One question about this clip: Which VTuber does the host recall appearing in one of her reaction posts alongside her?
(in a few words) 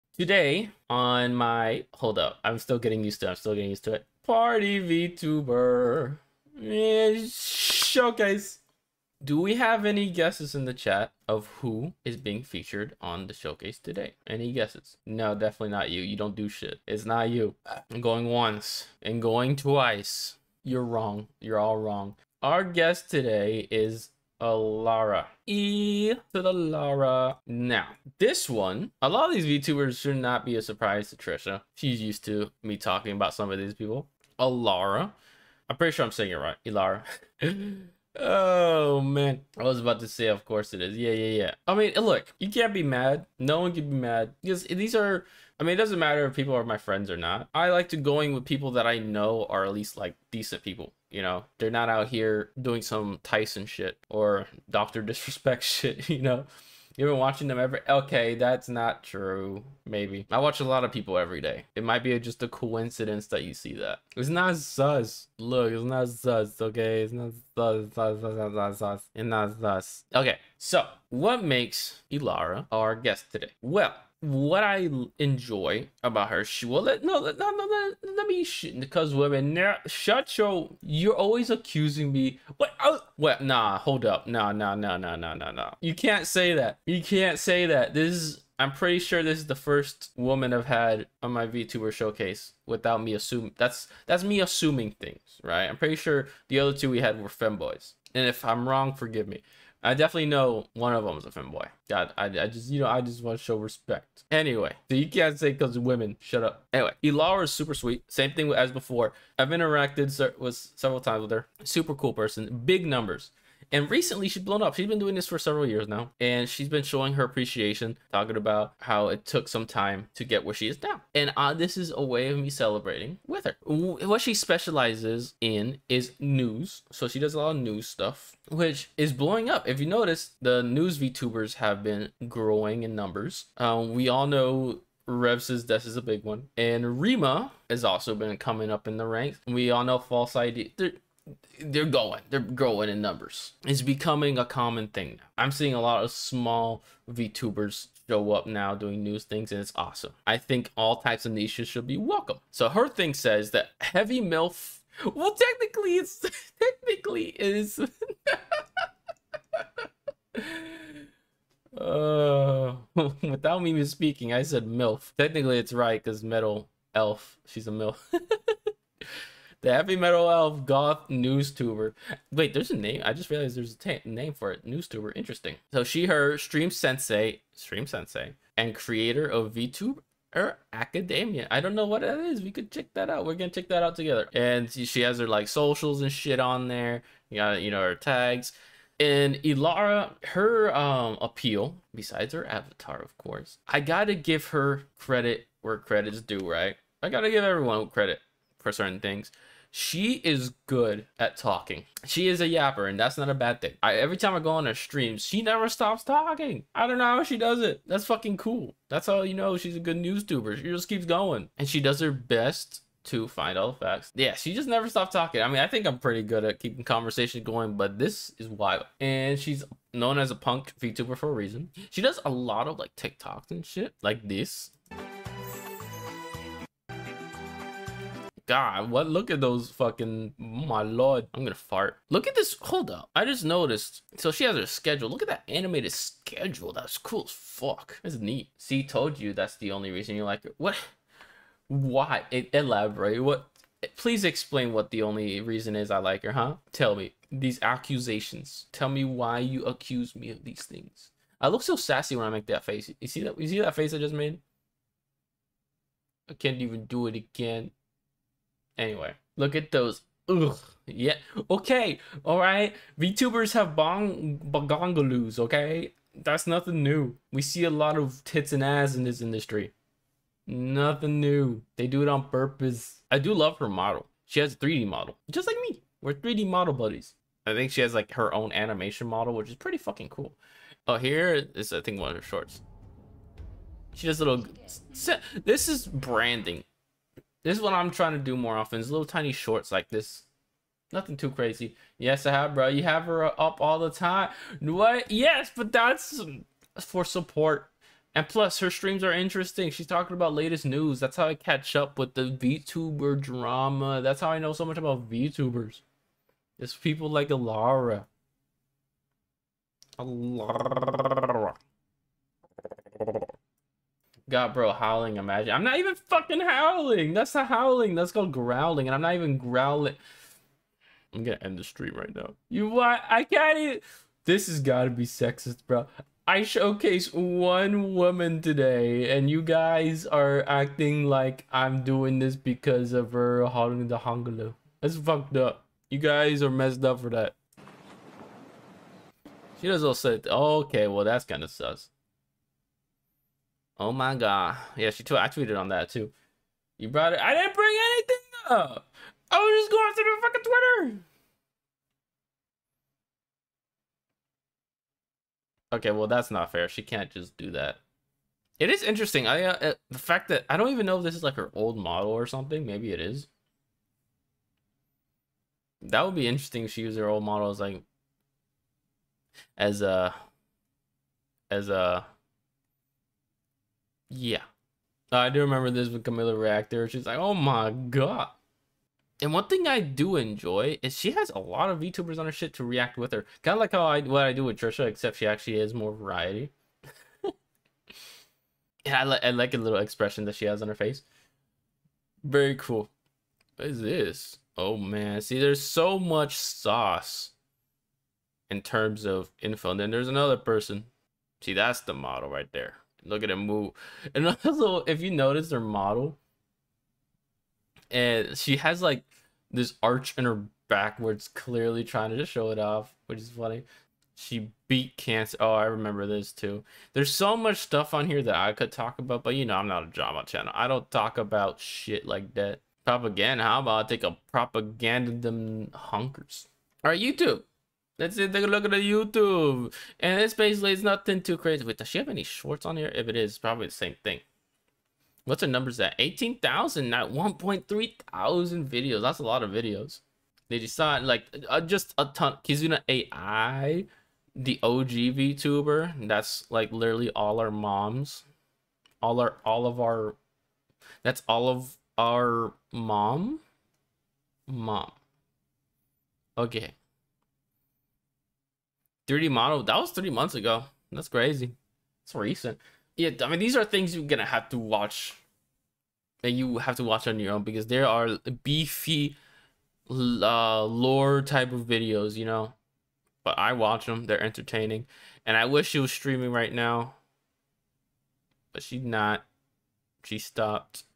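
Camilla Reactor.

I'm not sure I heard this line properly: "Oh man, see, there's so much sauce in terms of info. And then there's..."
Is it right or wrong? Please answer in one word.
right.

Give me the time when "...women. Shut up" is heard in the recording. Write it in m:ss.
1:45.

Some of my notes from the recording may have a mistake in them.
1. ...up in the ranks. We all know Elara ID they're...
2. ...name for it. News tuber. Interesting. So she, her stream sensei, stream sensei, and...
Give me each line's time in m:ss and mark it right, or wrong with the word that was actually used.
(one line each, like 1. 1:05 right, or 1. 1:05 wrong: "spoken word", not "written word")
1. 2:18 wrong: "False", not "Elara"
2. 2:54 right.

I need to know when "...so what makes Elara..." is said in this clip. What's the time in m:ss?
1:10.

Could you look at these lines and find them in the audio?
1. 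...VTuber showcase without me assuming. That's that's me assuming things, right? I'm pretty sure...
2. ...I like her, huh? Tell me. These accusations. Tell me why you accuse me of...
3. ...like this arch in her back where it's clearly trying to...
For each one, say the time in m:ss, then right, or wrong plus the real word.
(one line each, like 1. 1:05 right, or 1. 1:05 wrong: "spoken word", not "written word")
1. 1:31 right
2. 4:05 right
3. 6:48 right.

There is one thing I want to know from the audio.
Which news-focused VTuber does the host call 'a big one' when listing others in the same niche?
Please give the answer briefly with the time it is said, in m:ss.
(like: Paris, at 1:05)
Rev Says Desu, at 2:15.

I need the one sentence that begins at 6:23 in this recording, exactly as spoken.
Kind of like how I what I do with Trisha, except she actually has more variety.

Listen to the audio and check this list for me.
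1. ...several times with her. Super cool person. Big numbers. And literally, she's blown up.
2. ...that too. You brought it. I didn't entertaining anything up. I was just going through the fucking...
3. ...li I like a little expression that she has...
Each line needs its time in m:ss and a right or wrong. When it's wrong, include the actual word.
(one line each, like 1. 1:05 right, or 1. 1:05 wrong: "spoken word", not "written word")
1. 1:50 wrong: "recently", not "literally"
2. 5:45 wrong: "bring", not "entertaining"
3. 6:29 right.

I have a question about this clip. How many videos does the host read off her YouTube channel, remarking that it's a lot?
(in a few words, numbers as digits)
1,300.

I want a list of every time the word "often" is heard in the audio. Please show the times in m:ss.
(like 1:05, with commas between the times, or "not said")
4:48.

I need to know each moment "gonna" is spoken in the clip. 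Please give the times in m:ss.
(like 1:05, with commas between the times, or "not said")
3:03, 3:51, 5:21, 7:44.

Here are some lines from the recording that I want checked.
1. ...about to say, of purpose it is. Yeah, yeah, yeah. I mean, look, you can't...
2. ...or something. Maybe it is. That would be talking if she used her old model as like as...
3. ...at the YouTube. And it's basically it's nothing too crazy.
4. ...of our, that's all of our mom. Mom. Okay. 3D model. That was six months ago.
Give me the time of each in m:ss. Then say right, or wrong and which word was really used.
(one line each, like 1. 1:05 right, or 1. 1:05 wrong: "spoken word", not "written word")
1. 0:39 wrong: "course", not "purpose"
2. 6:02 wrong: "interesting", not "talking"
3. 7:08 right
4. 7:29 wrong: "three", not "six".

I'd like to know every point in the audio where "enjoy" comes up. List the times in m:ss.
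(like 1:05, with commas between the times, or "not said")
1:15, 6:20.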